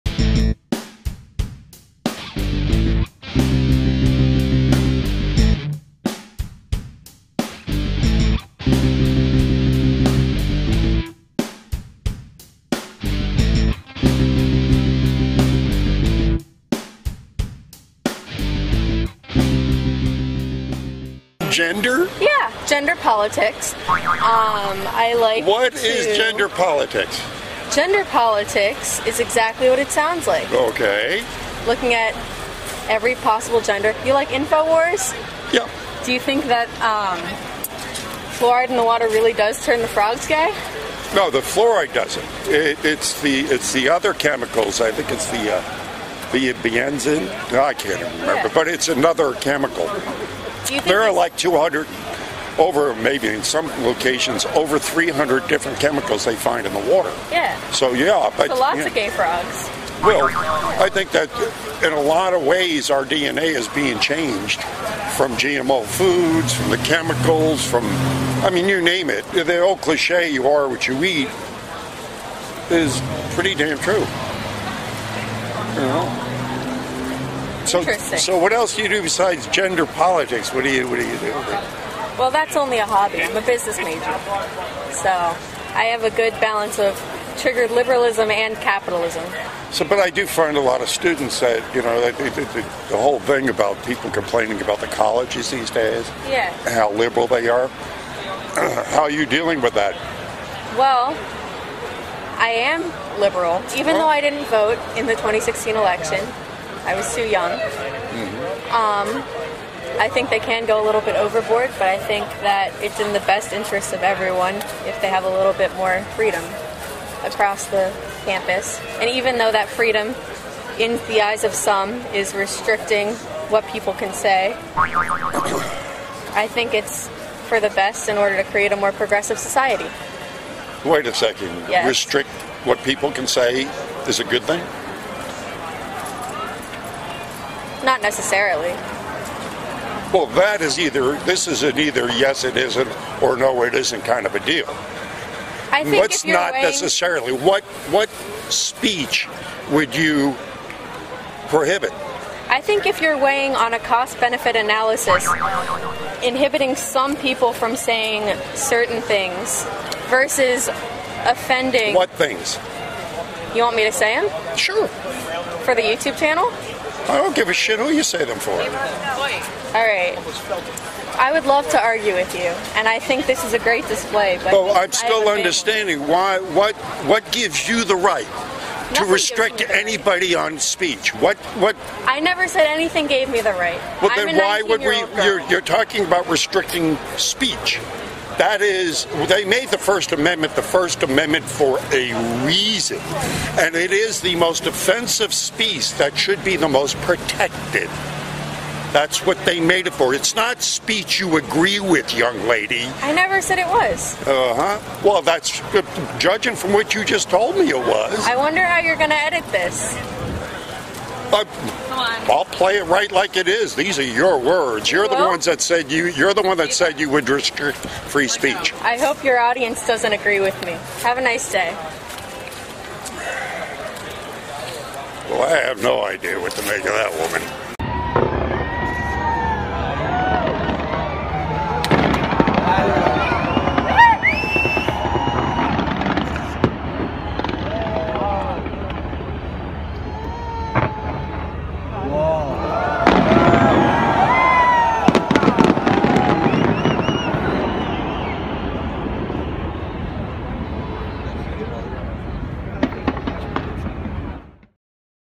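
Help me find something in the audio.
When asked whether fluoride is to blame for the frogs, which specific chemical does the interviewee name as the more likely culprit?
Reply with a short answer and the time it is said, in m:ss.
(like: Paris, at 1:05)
benzene, at 0:46.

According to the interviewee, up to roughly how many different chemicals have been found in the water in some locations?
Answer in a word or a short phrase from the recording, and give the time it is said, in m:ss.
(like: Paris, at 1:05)
300, at 0:54.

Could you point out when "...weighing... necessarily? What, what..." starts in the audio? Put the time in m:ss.
2:26.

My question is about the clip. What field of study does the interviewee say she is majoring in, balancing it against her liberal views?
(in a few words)
business.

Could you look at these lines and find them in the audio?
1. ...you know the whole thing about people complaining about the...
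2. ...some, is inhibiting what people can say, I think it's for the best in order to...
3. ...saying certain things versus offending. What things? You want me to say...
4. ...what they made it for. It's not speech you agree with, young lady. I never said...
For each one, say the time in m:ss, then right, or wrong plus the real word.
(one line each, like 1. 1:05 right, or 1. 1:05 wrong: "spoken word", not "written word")
1. 1:31 right
2. 2:01 wrong: "restricting", not "inhibiting"
3. 2:37 right
4. 3:19 right.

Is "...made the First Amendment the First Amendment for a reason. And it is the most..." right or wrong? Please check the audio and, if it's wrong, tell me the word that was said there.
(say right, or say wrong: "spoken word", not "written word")
right.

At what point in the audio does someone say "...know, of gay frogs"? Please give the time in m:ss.
0:58.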